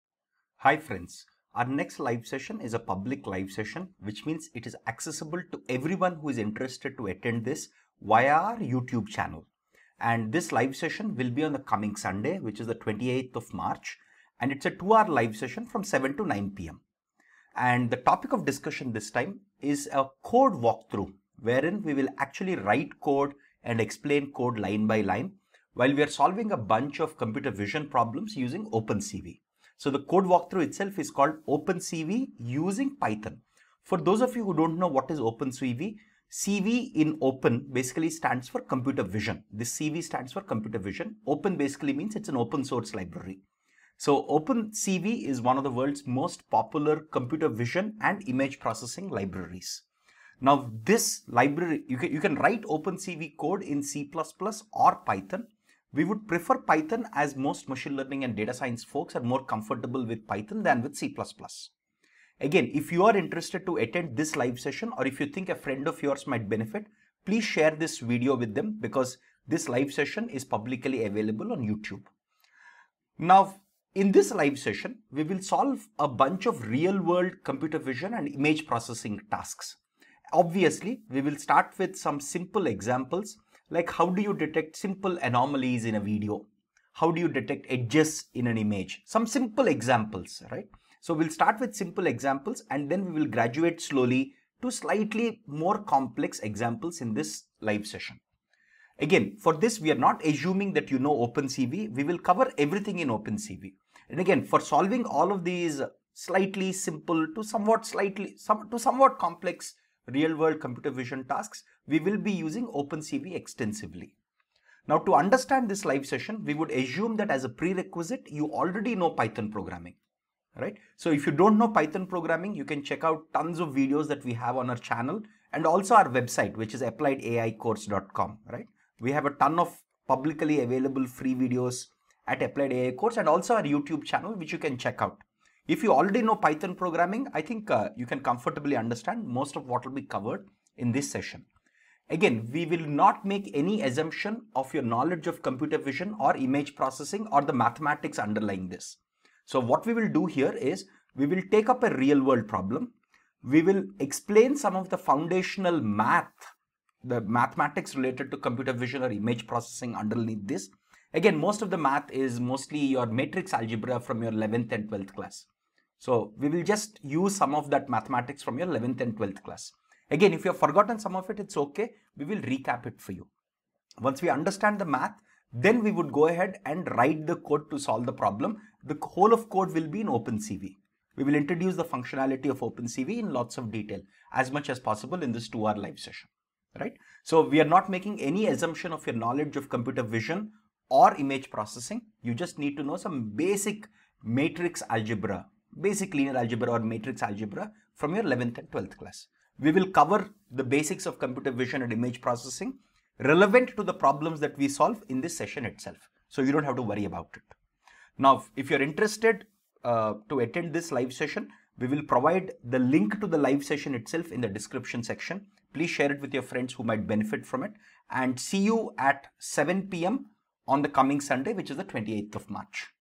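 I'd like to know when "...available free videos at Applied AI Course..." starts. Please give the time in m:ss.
2:10.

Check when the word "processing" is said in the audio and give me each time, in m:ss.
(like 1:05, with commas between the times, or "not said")
0:48, 1:18, 2:26, 2:39, 3:11, 3:22.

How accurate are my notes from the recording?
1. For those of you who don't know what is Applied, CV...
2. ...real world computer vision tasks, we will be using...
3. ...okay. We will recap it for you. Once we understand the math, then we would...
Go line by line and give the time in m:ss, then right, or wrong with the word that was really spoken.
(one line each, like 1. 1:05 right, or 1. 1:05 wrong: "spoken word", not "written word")
1. 0:33 wrong: "OpenCV", not "Applied"
2. 1:50 right
3. 2:51 right.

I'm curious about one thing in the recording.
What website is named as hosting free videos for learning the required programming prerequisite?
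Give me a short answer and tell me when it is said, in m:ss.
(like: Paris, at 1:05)
appliedaicourse.com, at 2:06.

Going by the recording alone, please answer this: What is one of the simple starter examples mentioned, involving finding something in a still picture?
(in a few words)
detect edges.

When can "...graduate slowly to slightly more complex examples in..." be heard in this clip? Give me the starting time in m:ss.
1:33.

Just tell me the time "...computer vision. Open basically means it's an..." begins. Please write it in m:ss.
0:40.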